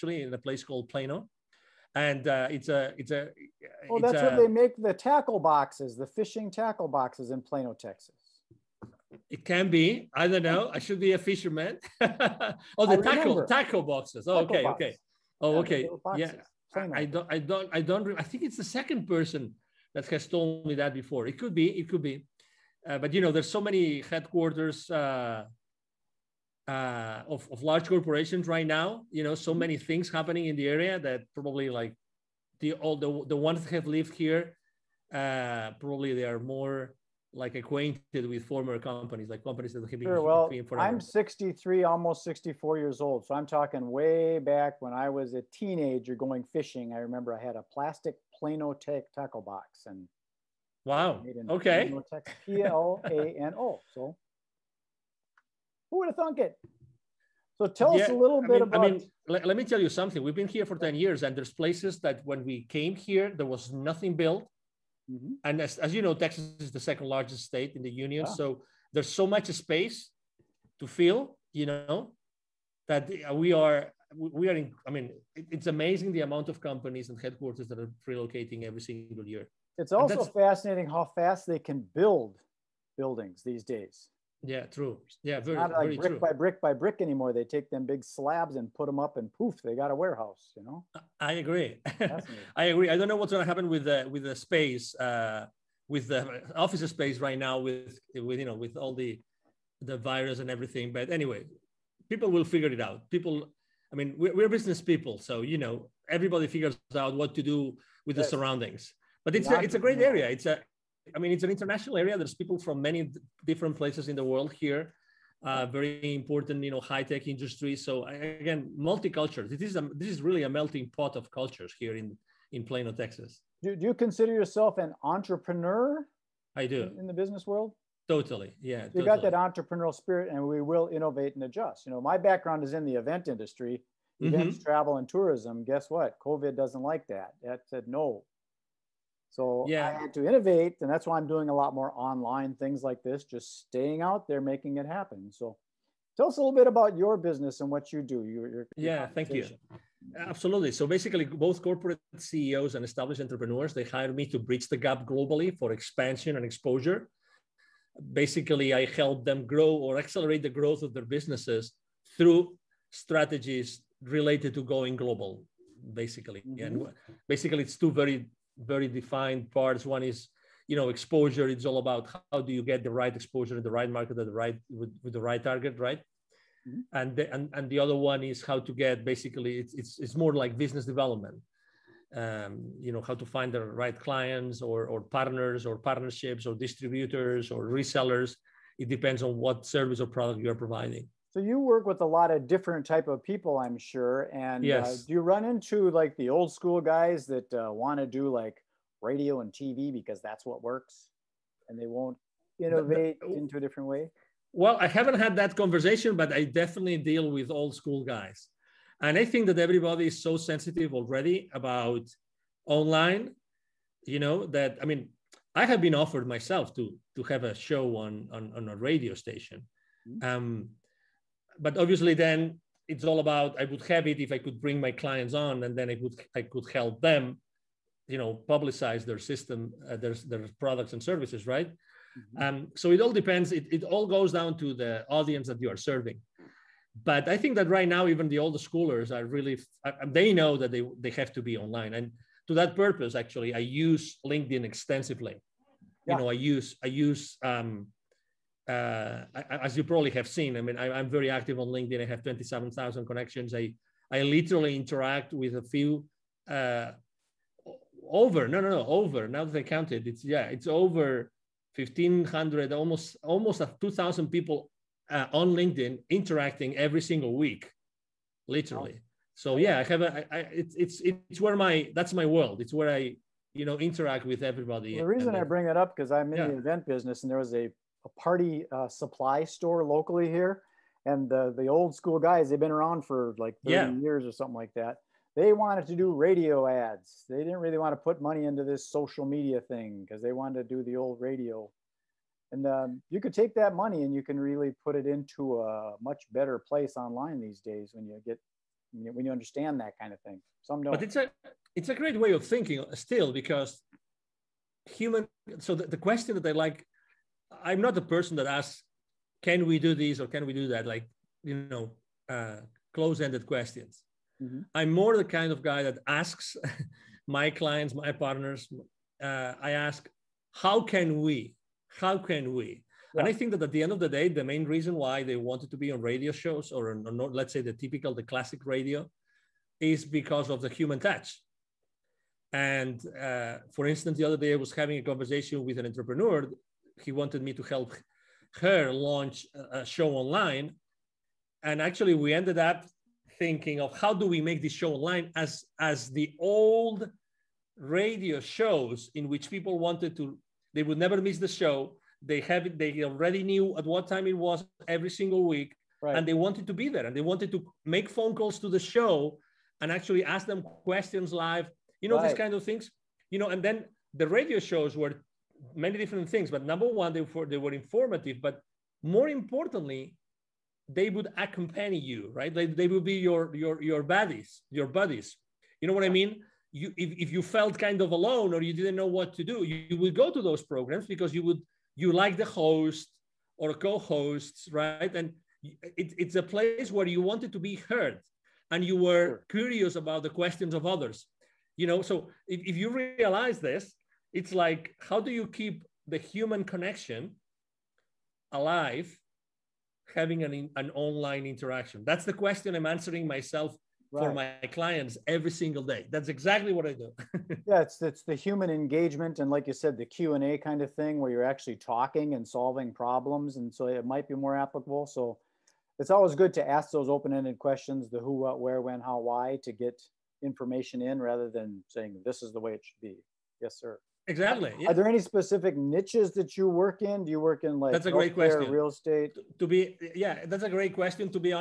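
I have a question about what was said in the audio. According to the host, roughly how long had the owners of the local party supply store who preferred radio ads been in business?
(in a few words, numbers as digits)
30 years.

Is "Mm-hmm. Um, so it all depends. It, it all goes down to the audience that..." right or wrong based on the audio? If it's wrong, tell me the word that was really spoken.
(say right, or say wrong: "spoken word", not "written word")
right.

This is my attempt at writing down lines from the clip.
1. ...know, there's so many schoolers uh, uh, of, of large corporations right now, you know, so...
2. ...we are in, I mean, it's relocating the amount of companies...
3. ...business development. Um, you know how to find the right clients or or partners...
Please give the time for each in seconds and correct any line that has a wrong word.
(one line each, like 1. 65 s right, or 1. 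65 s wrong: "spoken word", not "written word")
1. 23 s wrong: "headquarters", not "schoolers"
2. 74 s wrong: "amazing", not "relocating"
3. 180 s right.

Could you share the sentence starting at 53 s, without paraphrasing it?
So who would have thunk it?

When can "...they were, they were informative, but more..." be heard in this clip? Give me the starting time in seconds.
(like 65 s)
367 s.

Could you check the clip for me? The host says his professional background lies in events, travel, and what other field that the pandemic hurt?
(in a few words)
tourism.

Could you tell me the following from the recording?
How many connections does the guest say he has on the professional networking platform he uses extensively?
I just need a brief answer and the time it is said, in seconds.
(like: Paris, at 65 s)
27,000, at 252 s.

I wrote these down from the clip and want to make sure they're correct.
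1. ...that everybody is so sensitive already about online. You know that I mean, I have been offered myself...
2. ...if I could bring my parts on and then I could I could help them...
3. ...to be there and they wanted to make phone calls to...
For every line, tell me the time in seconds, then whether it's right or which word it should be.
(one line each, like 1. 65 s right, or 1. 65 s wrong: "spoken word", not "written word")
1. 209 s right
2. 224 s wrong: "clients", not "parts"
3. 356 s right.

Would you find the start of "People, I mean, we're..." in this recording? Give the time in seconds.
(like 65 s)
103 s.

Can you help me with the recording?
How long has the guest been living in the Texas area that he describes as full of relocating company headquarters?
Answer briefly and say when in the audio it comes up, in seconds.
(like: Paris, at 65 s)
10 years, at 60 s.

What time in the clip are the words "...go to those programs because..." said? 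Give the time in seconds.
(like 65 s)
380 s.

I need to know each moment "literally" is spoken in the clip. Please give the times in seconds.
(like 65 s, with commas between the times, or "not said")
254 s, 268 s.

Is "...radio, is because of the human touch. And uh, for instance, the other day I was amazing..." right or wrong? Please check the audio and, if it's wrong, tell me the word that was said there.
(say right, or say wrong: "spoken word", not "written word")
wrong: "having", not "amazing".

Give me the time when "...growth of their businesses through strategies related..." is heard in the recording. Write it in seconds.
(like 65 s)
160 s.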